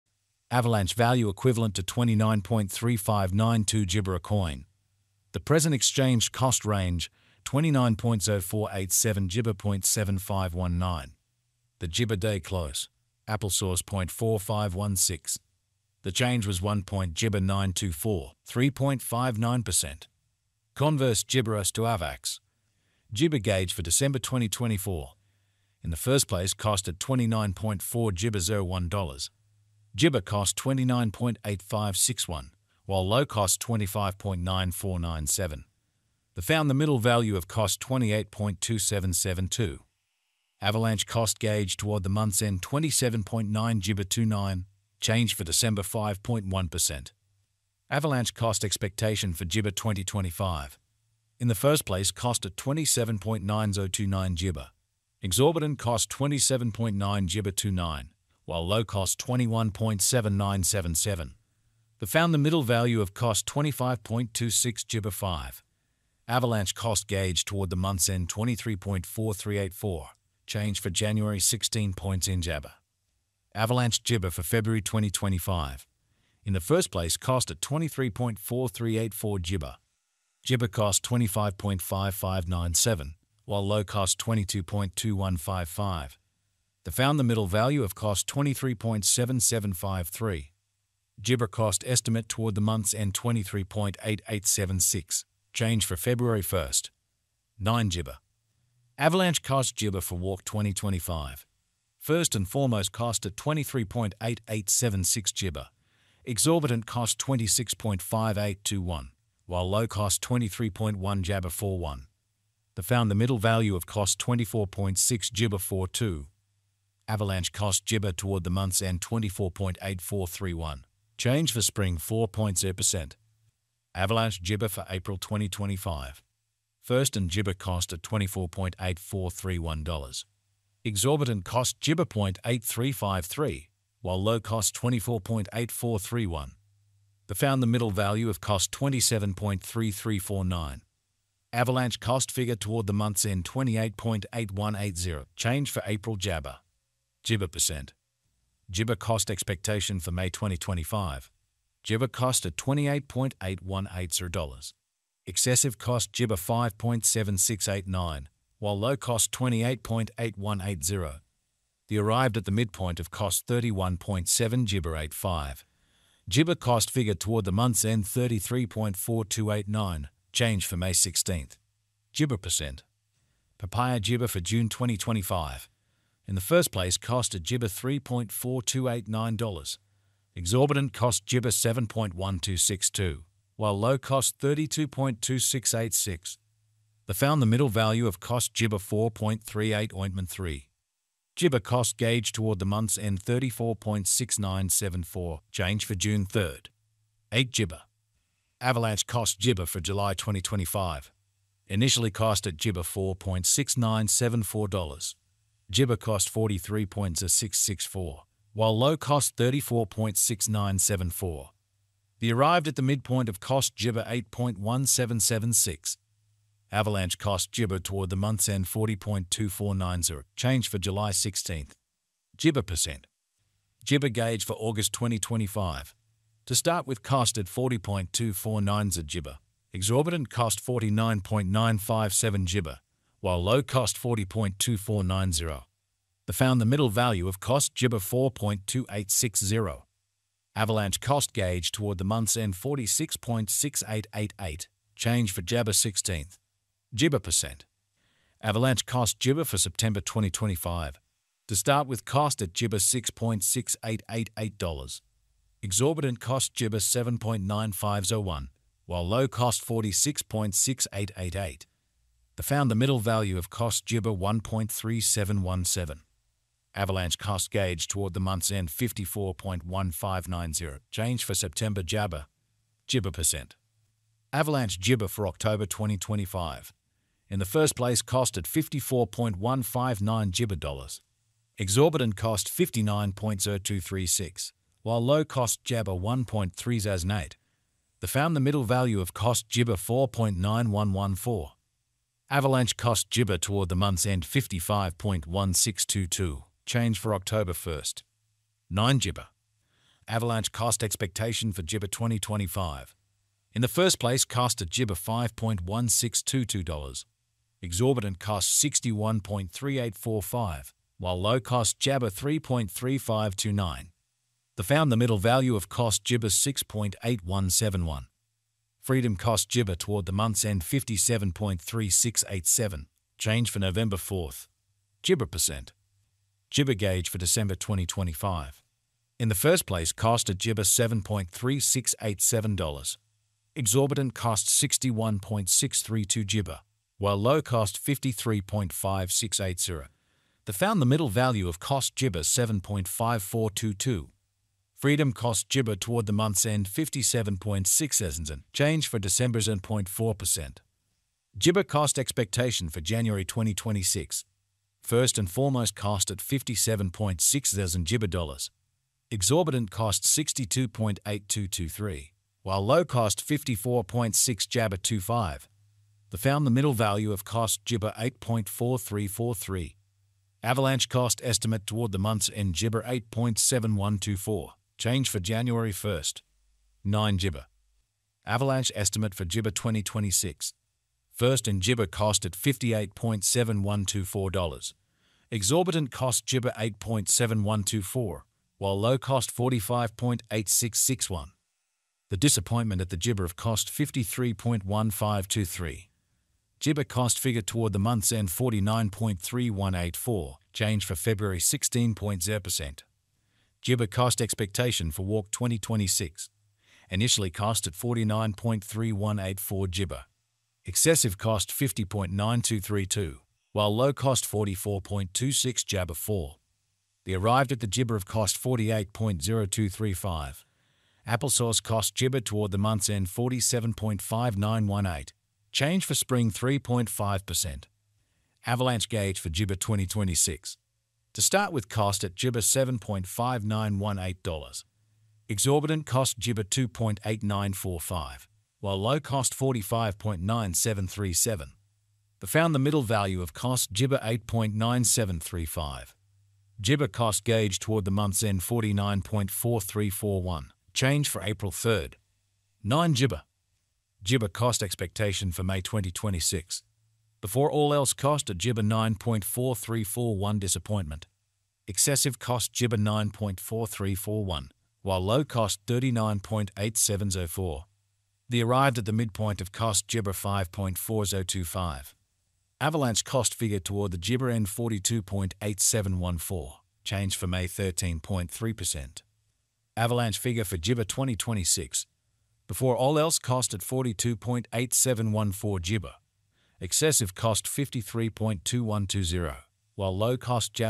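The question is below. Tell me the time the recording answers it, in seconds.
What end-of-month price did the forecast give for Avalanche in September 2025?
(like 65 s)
268 s.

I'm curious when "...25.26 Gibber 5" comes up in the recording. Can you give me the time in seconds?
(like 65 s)
63 s.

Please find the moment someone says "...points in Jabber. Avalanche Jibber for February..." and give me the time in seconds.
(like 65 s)
71 s.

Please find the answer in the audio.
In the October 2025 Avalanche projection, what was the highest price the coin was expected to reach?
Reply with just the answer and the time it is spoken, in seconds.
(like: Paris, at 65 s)
59.0236, at 282 s.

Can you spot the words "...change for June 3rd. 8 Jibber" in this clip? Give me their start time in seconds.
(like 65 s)
195 s.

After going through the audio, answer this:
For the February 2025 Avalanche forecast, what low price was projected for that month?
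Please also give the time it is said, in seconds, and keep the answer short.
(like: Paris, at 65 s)
22.2155, at 84 s.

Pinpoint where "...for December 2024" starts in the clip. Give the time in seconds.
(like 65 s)
23 s.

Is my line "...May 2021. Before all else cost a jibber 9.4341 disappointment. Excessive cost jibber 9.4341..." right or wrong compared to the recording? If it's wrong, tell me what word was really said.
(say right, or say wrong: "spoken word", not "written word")
wrong: "2026", not "2021".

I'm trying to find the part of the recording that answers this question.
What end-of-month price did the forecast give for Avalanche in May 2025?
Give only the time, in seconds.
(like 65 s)
168 s.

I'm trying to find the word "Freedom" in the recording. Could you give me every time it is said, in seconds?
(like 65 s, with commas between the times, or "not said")
318 s, 344 s.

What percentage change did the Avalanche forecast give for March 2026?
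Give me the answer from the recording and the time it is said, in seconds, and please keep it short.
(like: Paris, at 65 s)
3.5%, at 426 s.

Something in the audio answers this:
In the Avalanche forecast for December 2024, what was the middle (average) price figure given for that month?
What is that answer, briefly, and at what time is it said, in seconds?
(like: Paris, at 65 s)
28.2772, at 37 s.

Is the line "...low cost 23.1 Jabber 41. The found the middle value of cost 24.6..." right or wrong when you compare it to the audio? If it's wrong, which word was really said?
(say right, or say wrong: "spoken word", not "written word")
right.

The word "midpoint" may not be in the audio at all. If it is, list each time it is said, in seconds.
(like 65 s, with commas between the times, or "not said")
162 s, 212 s, 468 s.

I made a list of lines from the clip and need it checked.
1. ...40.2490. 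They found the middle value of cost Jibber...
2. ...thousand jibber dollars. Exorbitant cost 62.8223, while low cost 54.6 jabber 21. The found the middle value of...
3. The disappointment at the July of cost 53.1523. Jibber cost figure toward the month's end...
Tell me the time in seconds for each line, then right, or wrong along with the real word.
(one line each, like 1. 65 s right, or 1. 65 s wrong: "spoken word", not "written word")
1. 234 s right
2. 357 s wrong: "25", not "21"
3. 392 s wrong: "Jibber", not "July".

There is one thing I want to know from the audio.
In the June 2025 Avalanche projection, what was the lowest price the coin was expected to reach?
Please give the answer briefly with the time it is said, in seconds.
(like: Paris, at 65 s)
32.2686, at 184 s.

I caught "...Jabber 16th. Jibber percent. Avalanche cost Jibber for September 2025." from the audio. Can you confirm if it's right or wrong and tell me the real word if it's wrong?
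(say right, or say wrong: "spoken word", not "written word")
right.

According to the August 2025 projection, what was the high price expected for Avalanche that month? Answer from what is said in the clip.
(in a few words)
49.957.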